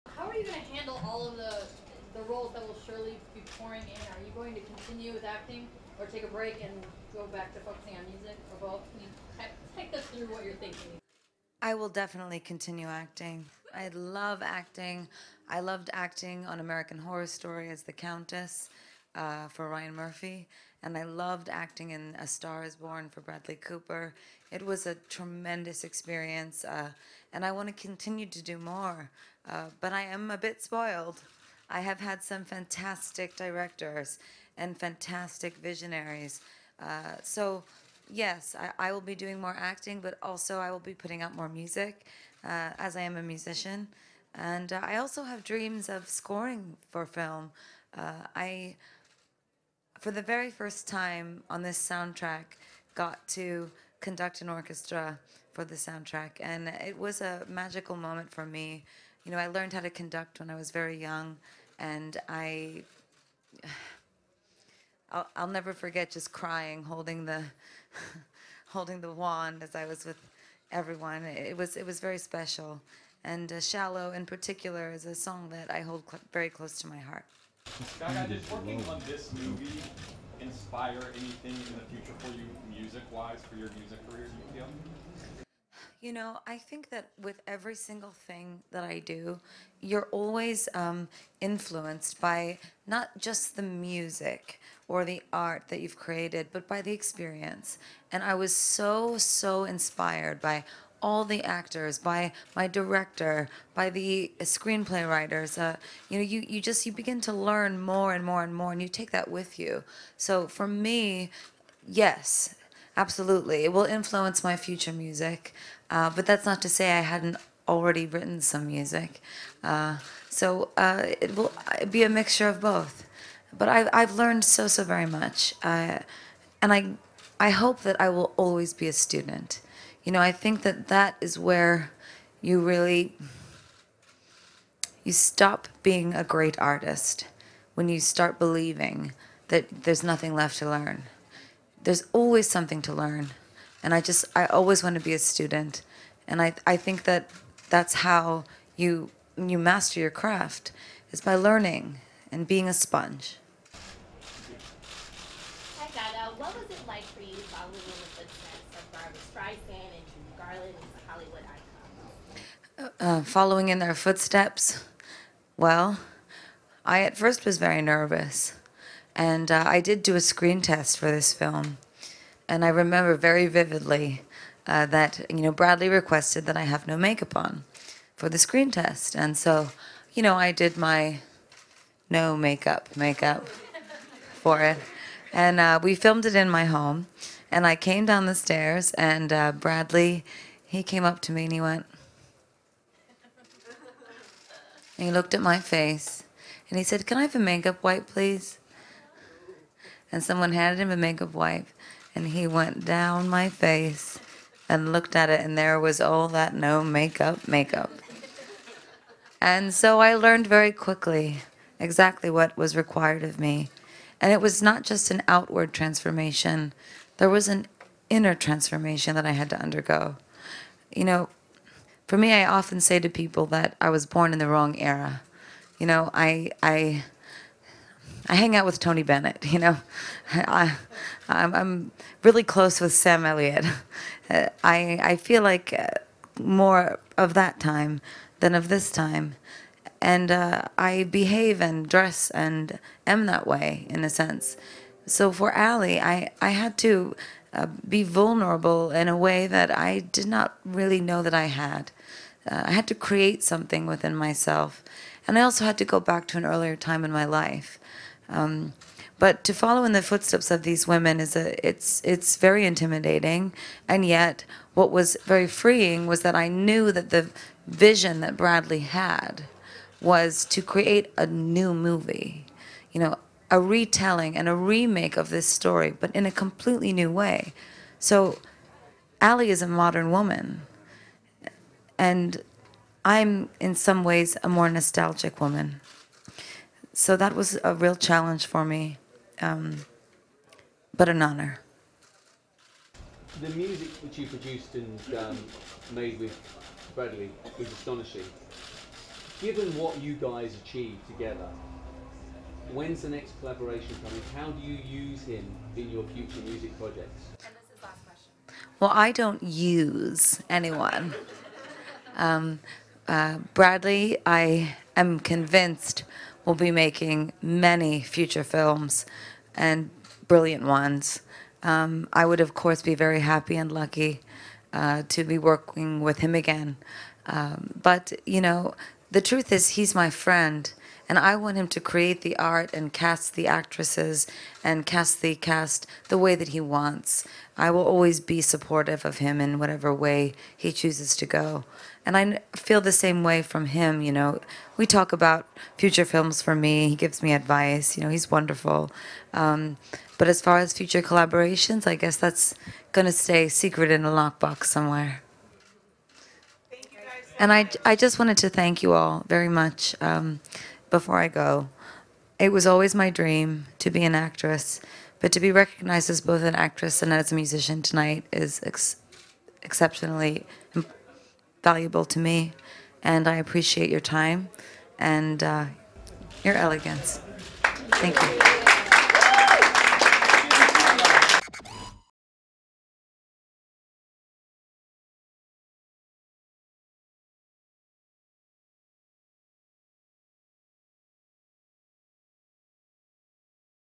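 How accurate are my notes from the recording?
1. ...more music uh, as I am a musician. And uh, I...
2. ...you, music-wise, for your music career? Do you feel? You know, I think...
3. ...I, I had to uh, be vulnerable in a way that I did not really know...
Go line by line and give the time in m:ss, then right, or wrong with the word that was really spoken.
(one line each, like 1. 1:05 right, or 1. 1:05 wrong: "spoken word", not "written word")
1. 0:41 right
2. 1:22 right
3. 4:05 right.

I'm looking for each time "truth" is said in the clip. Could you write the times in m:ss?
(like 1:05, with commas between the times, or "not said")
5:29.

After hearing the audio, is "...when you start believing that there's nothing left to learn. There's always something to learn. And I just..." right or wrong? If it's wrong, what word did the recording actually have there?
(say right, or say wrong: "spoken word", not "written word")
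right.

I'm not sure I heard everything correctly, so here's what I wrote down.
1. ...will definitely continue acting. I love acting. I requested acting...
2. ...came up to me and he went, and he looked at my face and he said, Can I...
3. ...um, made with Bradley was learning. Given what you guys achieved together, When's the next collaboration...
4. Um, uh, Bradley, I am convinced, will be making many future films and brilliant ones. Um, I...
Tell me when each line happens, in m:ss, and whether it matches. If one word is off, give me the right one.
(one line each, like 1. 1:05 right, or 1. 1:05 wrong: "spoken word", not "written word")
1. 0:11 wrong: "loved", not "requested"
2. 3:10 right
3. 4:55 wrong: "astonishing", not "learning"
4. 5:12 right.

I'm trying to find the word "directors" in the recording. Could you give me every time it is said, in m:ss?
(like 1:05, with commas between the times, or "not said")
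0:33, 1:42.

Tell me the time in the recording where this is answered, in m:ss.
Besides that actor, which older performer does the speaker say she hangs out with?
3:48.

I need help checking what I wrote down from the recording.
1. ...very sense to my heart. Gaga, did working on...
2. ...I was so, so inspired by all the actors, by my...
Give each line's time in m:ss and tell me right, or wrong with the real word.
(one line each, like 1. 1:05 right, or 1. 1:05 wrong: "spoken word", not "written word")
1. 1:16 wrong: "close", not "sense"
2. 1:38 right.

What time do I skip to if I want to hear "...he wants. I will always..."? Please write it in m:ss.
5:36.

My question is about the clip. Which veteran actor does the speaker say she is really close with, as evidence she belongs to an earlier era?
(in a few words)
Sam Elliott.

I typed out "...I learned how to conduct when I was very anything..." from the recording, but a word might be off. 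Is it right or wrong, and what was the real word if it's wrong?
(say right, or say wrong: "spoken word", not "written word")
wrong: "young", not "anything".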